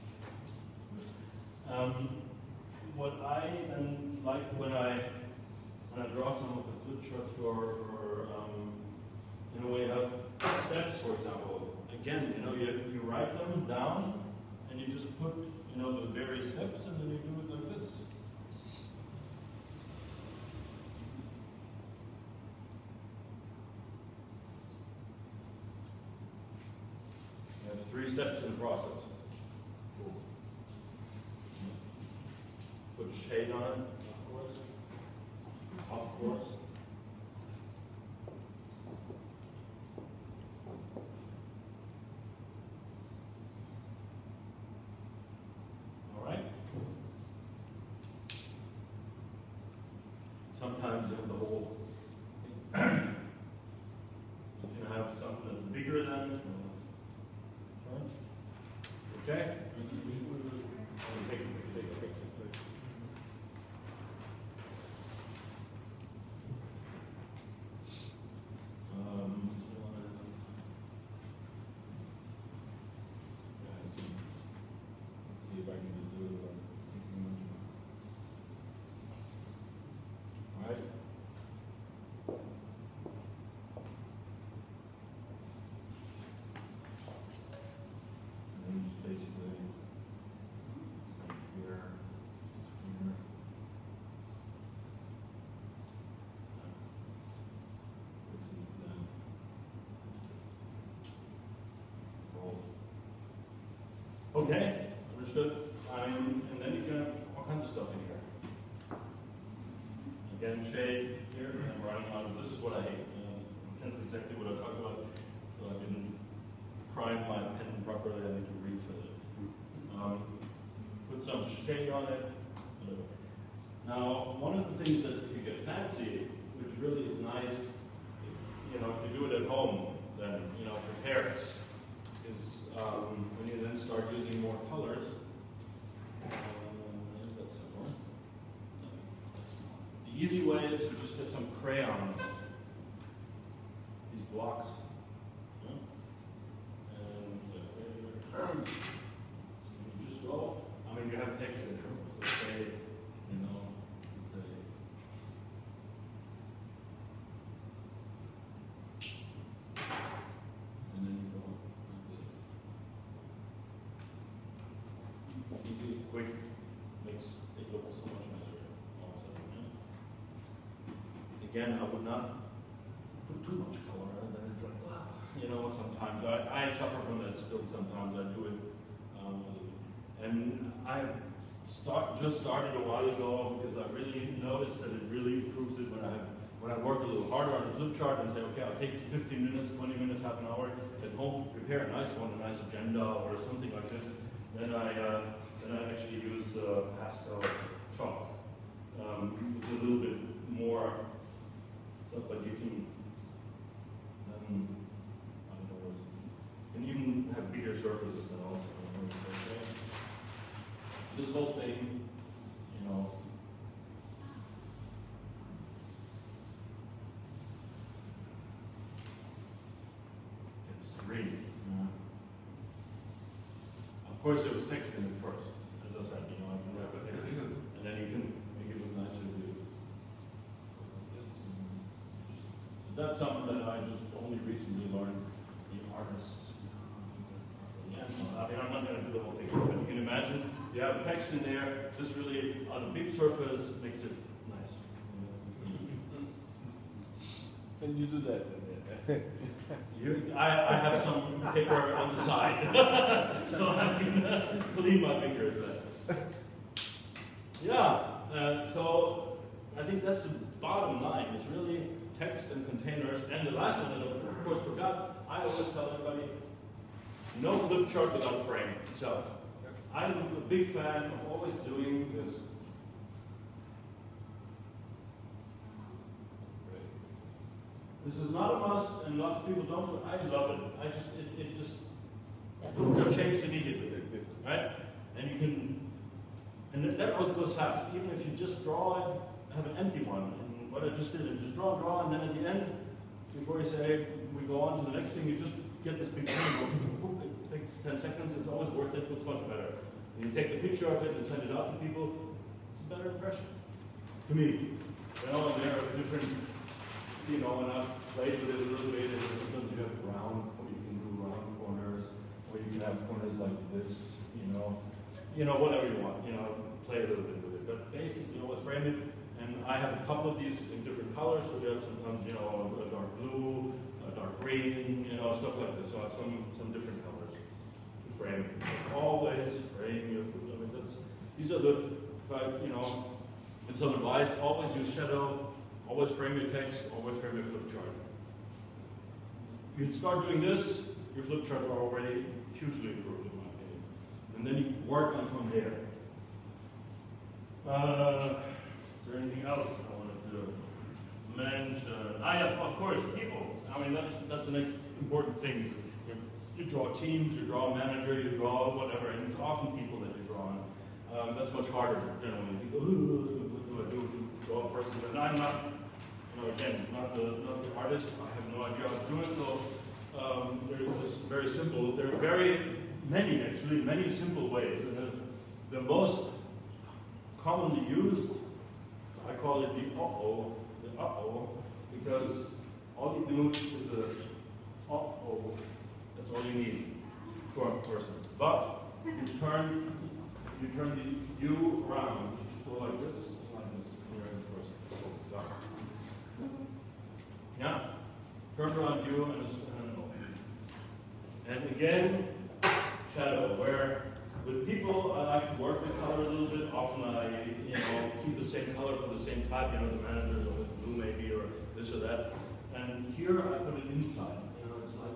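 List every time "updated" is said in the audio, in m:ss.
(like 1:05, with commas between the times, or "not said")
not said.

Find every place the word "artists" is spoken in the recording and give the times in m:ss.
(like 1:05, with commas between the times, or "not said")
3:55, 6:07.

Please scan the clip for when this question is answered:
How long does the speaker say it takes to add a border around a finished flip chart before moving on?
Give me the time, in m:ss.
4:57.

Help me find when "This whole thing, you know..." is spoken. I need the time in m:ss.
3:31.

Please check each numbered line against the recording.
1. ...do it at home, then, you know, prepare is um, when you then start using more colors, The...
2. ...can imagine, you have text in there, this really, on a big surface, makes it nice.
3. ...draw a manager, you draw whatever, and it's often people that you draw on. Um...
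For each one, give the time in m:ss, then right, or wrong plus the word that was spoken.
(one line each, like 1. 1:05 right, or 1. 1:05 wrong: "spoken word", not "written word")
1. 2:09 right
2. 3:59 right
3. 5:57 right.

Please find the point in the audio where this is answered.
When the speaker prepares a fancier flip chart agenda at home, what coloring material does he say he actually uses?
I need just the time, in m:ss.
3:16.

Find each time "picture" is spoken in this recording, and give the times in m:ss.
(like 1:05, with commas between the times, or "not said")
4:56, 5:00.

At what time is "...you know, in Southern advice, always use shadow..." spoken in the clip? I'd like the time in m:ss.
5:32.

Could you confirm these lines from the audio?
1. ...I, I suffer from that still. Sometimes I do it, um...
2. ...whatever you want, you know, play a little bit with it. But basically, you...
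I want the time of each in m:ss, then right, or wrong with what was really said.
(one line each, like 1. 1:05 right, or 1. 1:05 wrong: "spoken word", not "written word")
1. 2:56 right
2. 5:15 right.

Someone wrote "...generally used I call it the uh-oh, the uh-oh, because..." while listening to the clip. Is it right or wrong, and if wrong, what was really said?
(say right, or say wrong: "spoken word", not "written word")
wrong: "commonly", not "generally".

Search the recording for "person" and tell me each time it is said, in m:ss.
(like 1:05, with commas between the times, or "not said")
6:04, 6:27, 6:34.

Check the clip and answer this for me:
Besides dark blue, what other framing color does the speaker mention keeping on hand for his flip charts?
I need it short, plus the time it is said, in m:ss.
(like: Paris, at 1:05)
dark green, at 5:24.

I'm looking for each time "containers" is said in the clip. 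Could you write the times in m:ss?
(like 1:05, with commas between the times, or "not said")
4:22.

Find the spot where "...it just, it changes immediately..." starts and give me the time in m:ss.
4:41.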